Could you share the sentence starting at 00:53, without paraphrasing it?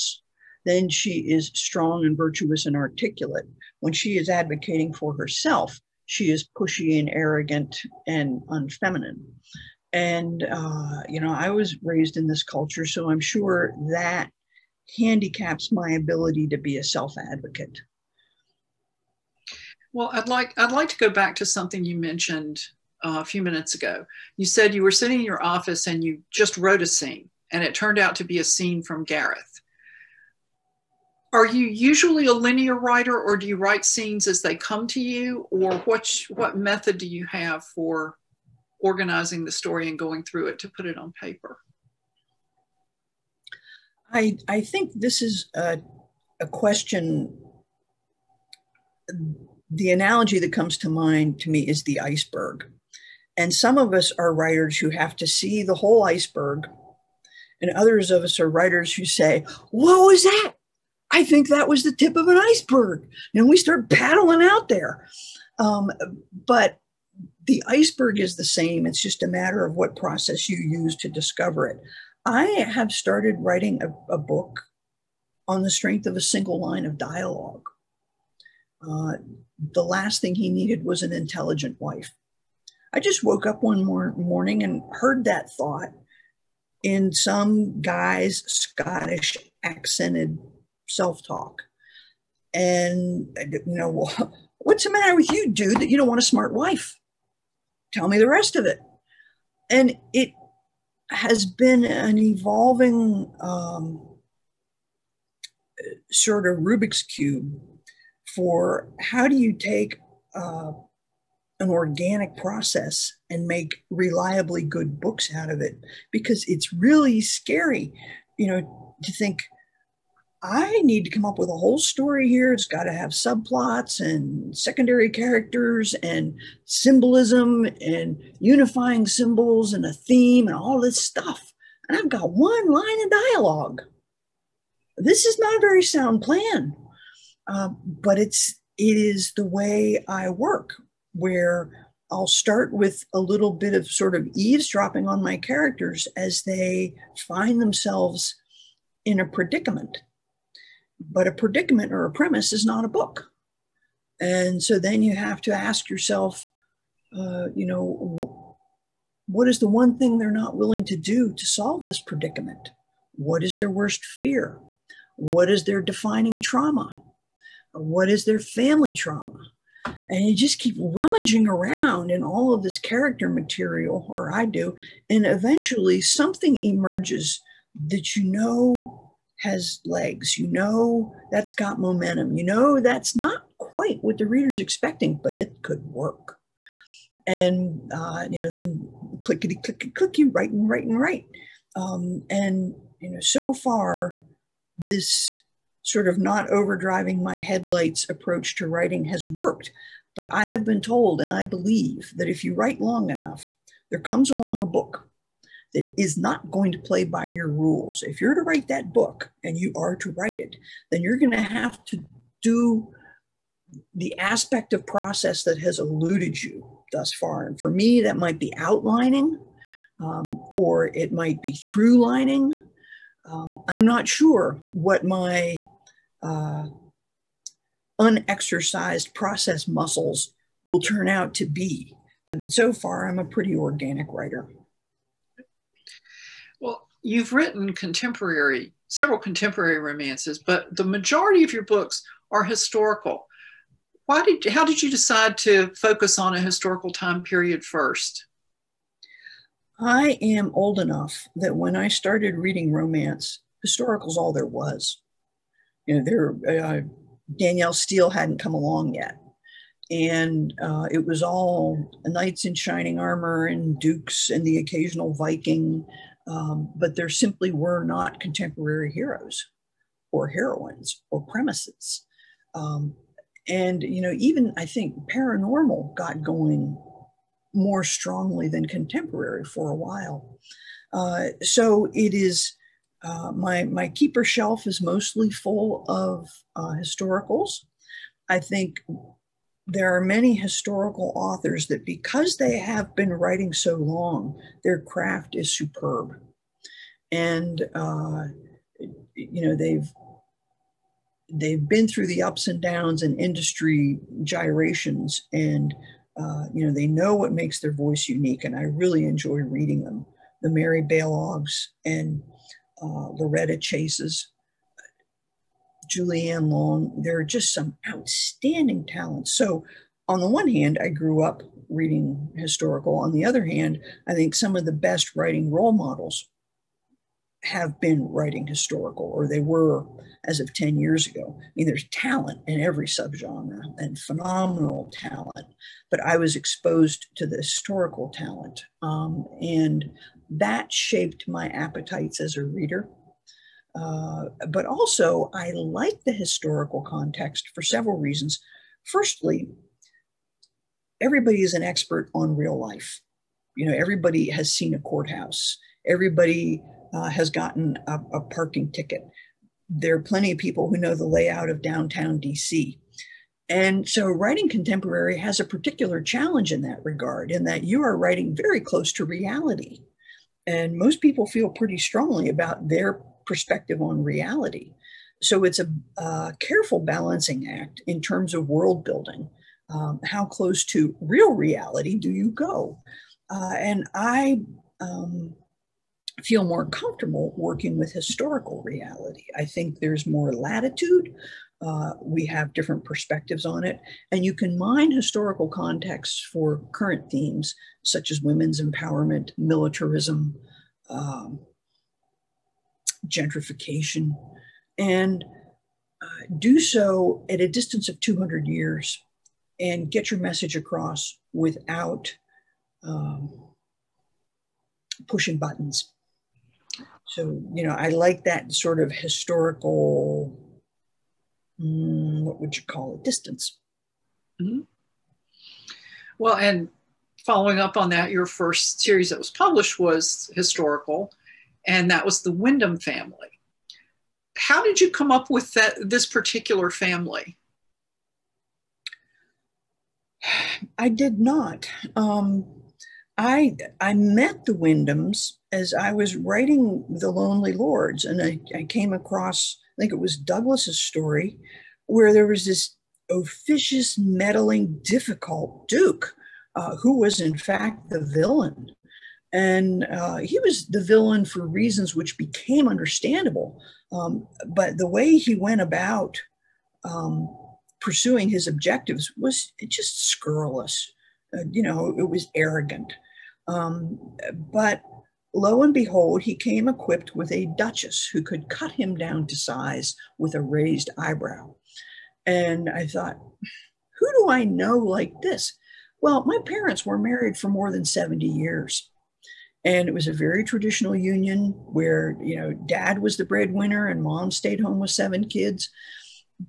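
And some of us are writers who have to see the whole iceberg.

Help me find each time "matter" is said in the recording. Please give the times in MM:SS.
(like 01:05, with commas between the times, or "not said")
01:09, 01:34.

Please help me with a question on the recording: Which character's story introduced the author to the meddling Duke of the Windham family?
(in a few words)
Douglas.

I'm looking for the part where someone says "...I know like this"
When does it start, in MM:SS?
08:04.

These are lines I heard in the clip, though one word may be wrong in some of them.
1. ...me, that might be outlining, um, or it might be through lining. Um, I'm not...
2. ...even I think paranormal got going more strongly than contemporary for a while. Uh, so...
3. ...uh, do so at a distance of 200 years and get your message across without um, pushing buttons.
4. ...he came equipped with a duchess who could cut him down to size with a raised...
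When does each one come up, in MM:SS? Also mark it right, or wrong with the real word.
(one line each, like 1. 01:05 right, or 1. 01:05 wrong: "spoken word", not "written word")
1. 03:37 right
2. 04:34 right
3. 06:46 right
4. 07:56 right.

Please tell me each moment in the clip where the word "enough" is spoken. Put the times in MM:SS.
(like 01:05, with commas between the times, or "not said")
03:23, 04:10.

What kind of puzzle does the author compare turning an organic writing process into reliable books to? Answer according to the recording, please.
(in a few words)
Rubik's Cube.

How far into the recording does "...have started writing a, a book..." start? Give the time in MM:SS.
01:12.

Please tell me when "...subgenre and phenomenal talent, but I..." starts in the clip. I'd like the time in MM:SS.
05:32.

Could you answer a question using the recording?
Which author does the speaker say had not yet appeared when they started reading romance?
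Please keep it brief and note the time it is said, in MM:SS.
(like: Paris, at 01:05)
Danielle Steel, at 04:17.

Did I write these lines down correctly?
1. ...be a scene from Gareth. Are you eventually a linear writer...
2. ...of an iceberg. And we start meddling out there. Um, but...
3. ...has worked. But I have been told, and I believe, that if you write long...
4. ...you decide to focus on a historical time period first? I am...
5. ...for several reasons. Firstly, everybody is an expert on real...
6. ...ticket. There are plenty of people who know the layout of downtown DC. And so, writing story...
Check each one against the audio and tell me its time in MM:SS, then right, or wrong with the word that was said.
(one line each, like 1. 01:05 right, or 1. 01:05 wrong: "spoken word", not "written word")
1. 00:28 wrong: "usually", not "eventually"
2. 01:02 wrong: "paddling", not "meddling"
3. 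03:19 right
4. 04:04 right
5. 05:47 right
6. 05:58 wrong: "contemporary", not "story".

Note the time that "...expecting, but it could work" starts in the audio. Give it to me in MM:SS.
03:04.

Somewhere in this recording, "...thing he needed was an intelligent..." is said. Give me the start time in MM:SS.
01:20.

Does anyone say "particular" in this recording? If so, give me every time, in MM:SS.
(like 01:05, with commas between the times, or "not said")
06:05, 07:16.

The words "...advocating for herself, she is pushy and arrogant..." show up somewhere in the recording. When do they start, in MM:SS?
00:04.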